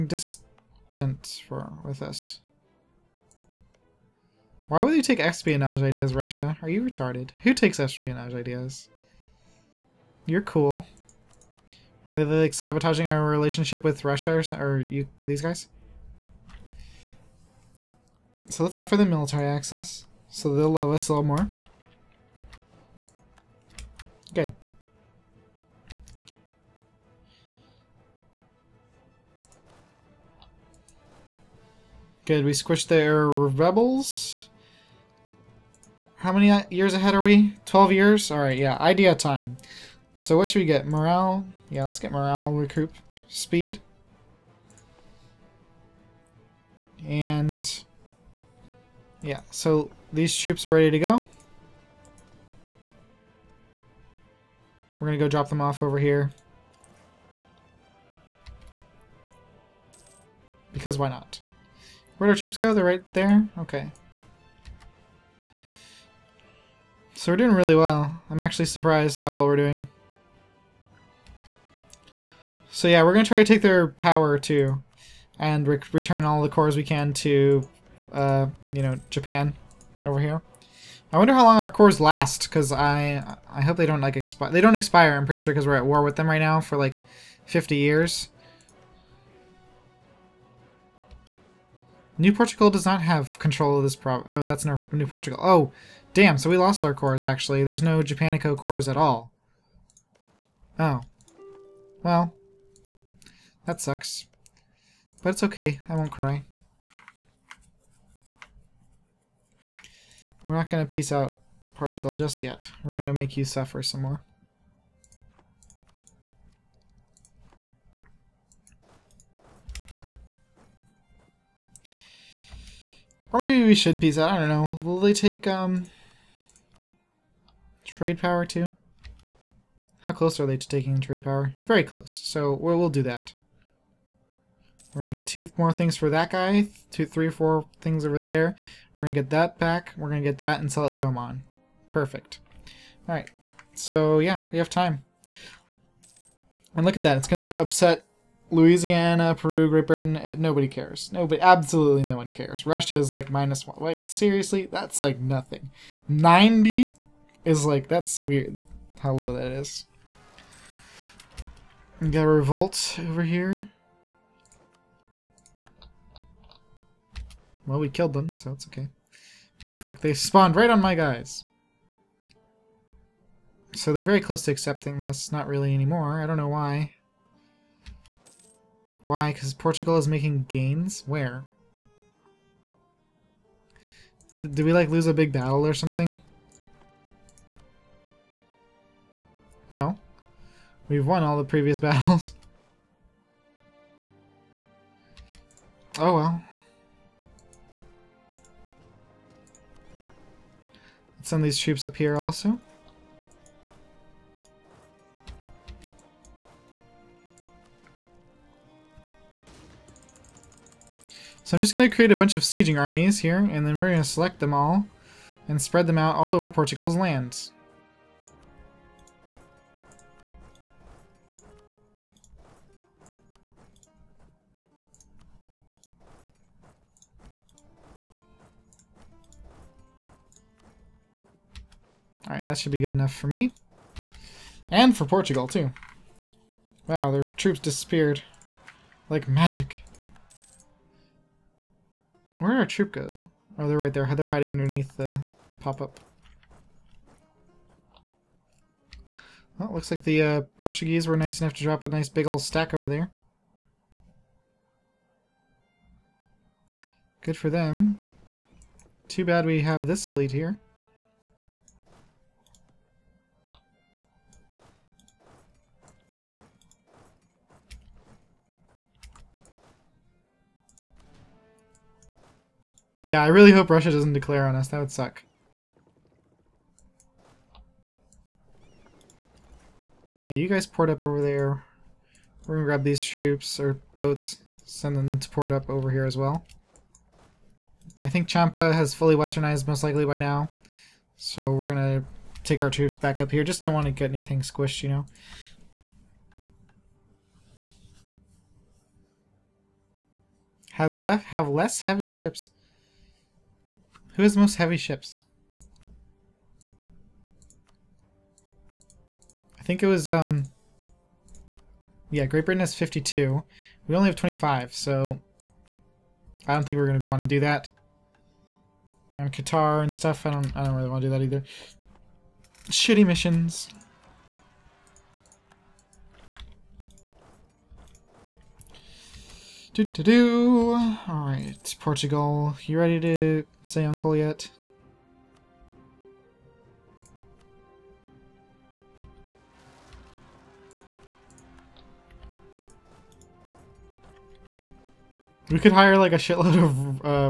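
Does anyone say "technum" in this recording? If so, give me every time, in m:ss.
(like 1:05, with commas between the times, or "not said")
not said.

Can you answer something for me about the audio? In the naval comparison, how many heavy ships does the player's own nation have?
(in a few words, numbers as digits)
25.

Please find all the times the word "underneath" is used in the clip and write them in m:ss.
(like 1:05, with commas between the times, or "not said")
4:04.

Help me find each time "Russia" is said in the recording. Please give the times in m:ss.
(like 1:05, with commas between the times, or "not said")
0:06, 0:14, 2:32, 4:33.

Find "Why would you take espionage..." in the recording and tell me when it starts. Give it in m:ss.
0:04.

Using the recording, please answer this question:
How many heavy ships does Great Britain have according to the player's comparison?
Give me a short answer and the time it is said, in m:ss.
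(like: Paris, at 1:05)
52, at 5:12.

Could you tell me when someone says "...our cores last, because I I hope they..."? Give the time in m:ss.
1:21.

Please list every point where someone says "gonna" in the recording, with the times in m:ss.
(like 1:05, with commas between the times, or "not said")
4:42, 4:51.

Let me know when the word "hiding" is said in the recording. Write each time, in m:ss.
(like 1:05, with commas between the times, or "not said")
4:04.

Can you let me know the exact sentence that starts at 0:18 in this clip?
So let's offer them military access.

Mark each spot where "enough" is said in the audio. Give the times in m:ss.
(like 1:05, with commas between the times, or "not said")
3:52, 4:11.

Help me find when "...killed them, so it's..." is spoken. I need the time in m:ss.
2:47.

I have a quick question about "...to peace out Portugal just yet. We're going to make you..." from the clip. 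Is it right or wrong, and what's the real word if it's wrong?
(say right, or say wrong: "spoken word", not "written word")
right.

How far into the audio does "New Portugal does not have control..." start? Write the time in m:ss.
1:32.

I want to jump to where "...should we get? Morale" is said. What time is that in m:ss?
0:40.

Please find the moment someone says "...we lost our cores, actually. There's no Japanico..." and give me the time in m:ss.
1:36.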